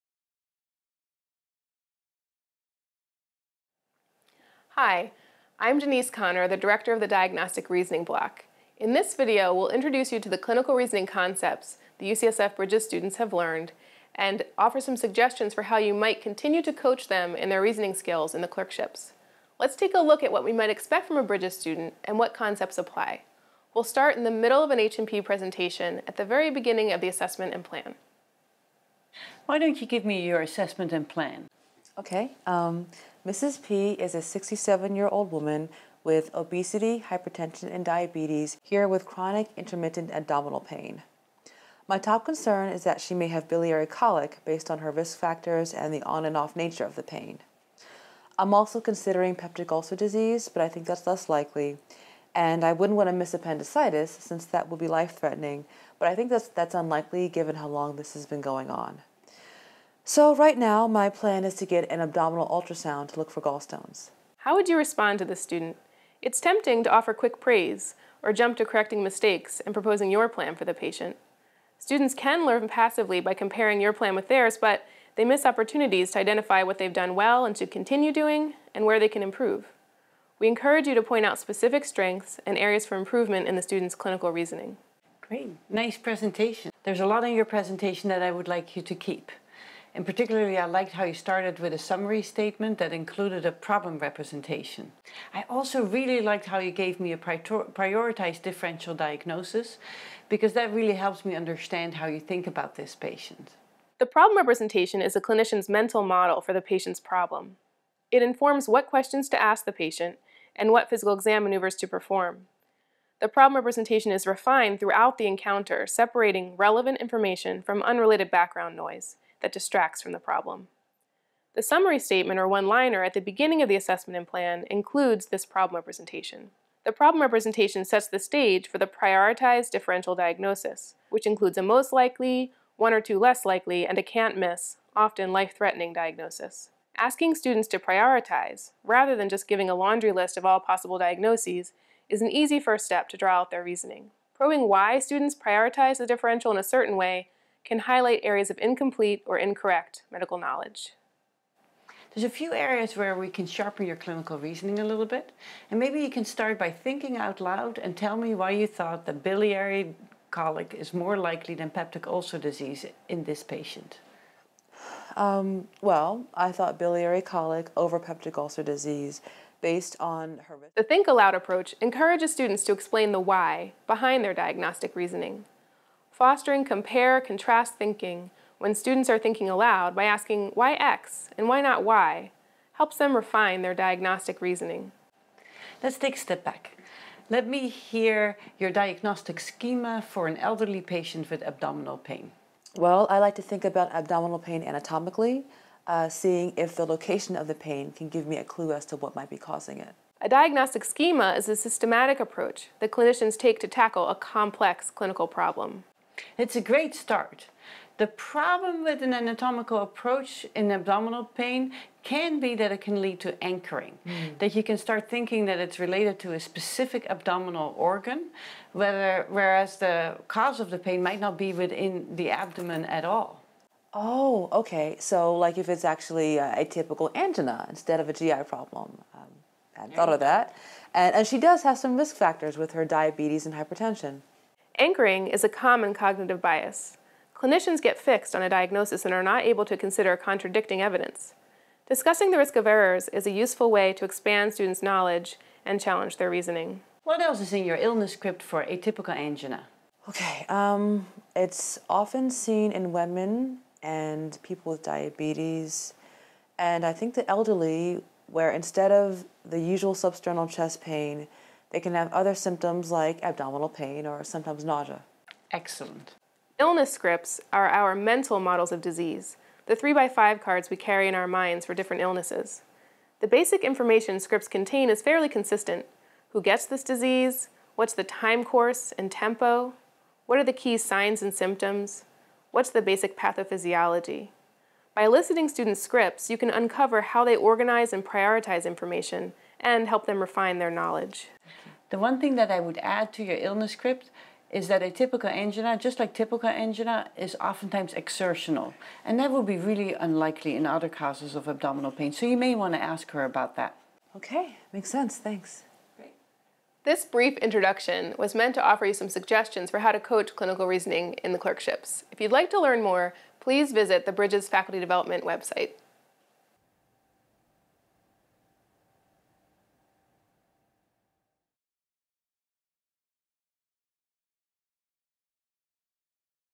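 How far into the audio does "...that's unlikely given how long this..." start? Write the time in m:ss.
0:56.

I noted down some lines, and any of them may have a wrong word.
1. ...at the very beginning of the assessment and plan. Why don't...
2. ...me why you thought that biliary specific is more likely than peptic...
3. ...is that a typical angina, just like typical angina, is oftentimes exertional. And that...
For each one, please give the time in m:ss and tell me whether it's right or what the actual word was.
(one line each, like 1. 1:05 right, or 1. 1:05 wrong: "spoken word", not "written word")
1. 0:26 right
2. 2:38 wrong: "colic", not "specific"
3. 4:54 right.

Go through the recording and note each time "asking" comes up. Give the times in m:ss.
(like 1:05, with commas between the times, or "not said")
2:16, 3:00.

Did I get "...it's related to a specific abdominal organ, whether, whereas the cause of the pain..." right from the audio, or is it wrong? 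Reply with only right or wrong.
right.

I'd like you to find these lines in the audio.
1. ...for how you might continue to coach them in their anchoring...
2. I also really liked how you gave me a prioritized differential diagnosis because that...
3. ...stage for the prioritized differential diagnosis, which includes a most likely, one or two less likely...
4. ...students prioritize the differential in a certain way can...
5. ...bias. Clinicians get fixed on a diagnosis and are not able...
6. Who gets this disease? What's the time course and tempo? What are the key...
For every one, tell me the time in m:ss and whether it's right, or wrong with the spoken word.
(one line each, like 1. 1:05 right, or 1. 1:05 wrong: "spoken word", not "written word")
1. 0:15 wrong: "reasoning", not "anchoring"
2. 1:35 right
3. 2:08 right
4. 2:24 right
5. 3:56 right
6. 4:36 right.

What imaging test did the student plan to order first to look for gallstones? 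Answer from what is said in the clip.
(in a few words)
Abdominal ultrasound.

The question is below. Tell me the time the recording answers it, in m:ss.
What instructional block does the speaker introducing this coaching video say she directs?
0:07.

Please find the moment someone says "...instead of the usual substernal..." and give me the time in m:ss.
4:18.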